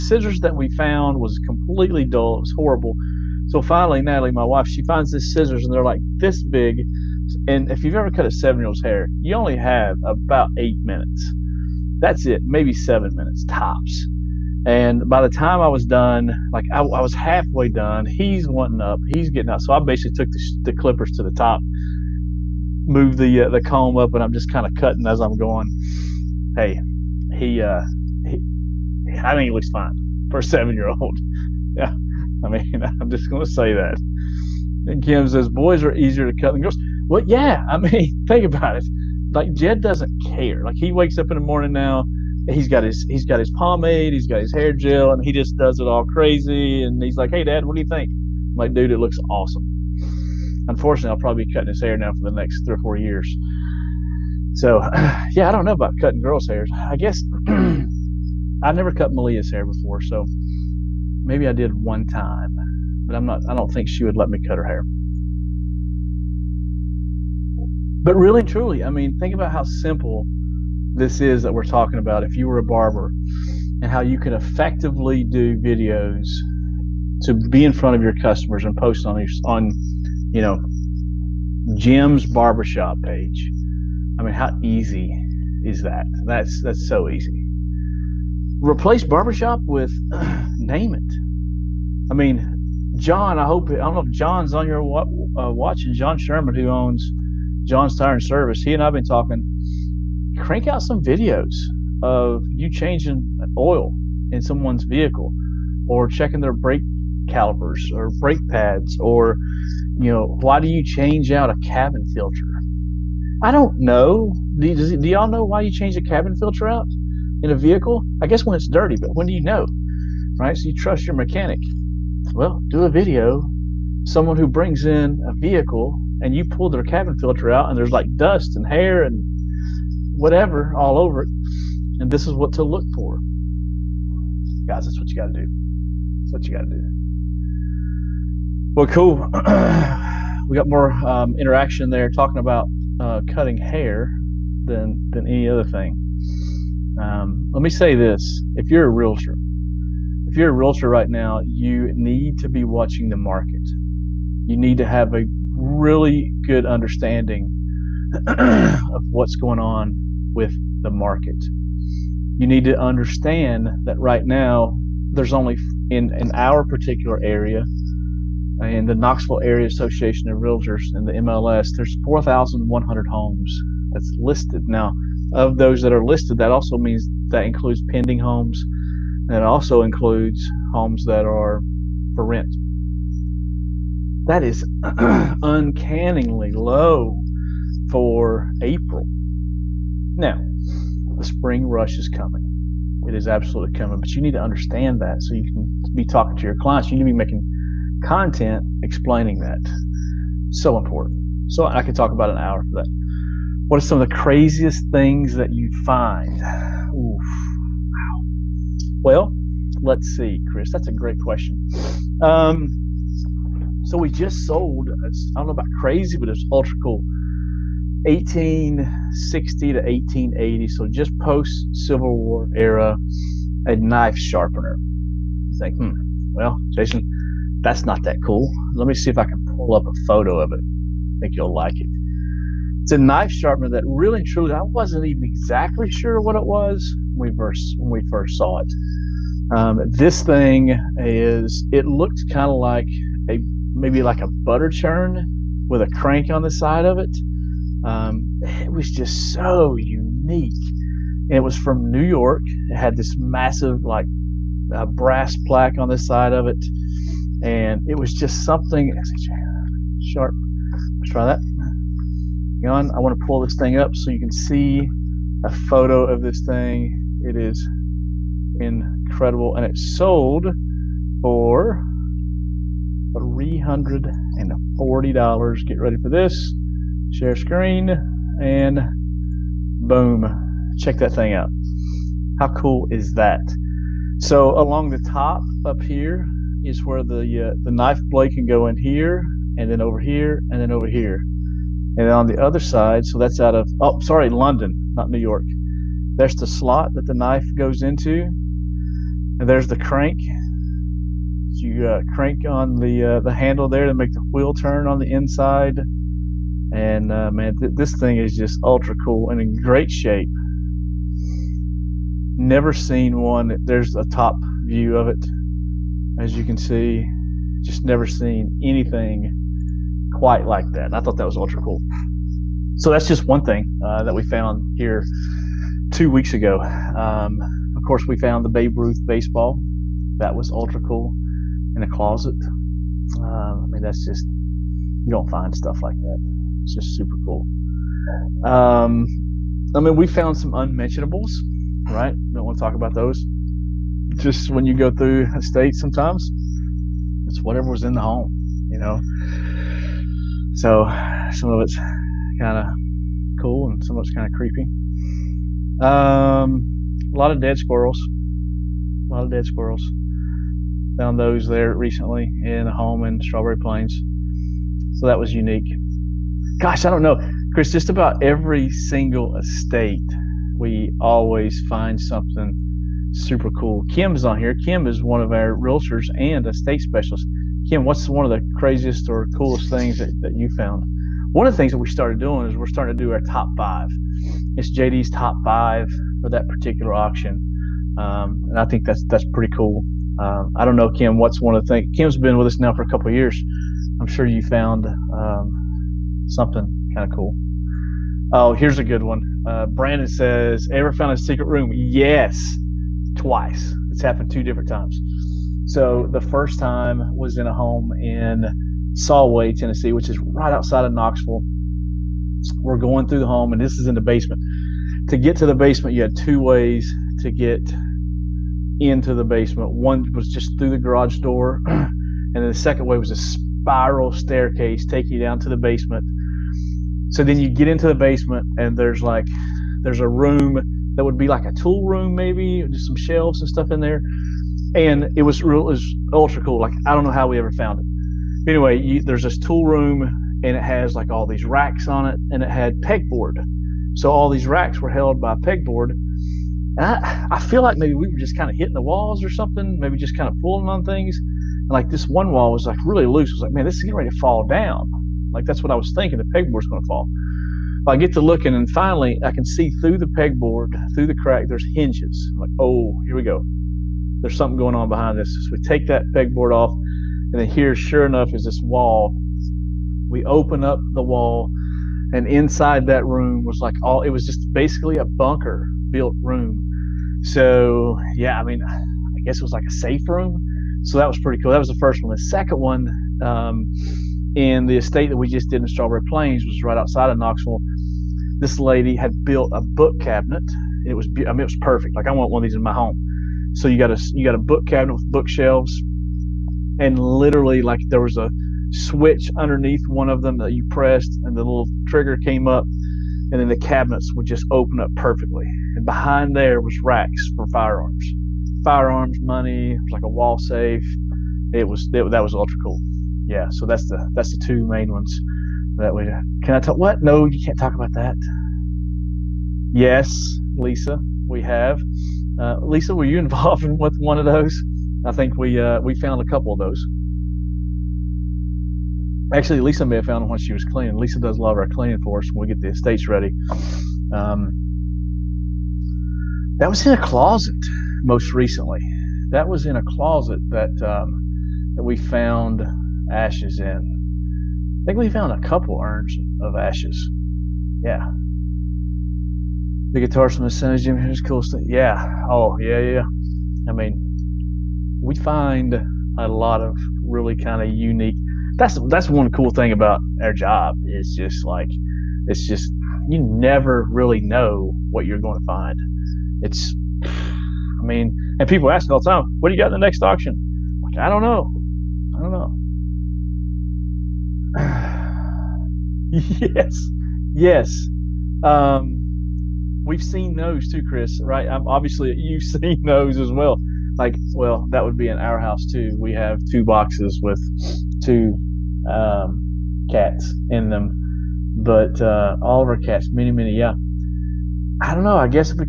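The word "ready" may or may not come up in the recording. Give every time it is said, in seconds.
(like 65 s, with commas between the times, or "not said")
275 s, 453 s, 533 s.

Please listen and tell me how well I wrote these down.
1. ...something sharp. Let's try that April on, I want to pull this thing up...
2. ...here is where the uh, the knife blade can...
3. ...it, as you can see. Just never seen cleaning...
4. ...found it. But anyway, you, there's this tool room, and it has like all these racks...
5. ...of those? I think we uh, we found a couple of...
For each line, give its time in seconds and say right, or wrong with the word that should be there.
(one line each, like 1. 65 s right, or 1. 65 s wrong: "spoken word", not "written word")
1. 258 s wrong: "Hang", not "April"
2. 285 s right
3. 315 s wrong: "anything", not "cleaning"
4. 437 s right
5. 524 s right.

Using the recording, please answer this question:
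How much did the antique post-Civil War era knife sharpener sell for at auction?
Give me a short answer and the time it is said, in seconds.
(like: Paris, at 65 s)
$340, at 273 s.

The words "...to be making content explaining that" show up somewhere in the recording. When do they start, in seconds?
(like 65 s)
197 s.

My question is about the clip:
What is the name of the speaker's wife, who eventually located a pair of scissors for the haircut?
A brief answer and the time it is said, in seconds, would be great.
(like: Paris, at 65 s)
Natalie, at 4 s.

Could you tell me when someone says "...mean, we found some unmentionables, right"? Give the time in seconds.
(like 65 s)
339 s.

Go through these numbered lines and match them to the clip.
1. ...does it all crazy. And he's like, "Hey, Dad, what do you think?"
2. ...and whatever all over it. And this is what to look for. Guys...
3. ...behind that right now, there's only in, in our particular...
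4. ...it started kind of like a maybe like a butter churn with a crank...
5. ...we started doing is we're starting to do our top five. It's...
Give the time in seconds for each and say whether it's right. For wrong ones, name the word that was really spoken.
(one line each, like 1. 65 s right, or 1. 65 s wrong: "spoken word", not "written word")
1. 45 s right
2. 129 s right
3. 162 s wrong: "understand", not "behind"
4. 241 s wrong: "looked", not "started"
5. 381 s right.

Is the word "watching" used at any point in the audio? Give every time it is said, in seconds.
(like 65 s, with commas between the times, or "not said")
95 s, 152 s.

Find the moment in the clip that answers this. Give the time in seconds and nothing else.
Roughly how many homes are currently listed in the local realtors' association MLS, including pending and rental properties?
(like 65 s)
172 s.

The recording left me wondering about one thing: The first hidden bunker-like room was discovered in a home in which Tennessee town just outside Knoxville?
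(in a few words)
Solway.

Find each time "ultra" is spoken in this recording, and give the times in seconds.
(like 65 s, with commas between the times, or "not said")
216 s, 308 s, 321 s, 330 s, 436 s, 512 s.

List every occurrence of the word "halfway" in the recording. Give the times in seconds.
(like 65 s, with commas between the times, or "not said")
17 s.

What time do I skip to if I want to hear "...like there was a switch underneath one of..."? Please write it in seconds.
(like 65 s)
497 s.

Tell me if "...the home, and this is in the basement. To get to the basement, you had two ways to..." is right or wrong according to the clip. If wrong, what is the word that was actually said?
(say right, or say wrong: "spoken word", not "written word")
right.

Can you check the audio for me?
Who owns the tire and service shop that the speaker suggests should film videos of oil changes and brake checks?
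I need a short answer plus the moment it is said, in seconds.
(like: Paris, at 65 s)
John Sherman, at 95 s.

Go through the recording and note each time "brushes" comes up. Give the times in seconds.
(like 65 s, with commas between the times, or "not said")
not said.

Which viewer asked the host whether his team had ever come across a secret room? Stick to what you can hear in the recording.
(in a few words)
Brandon.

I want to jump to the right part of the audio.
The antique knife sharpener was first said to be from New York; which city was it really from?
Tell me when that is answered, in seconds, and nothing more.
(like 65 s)
294 s.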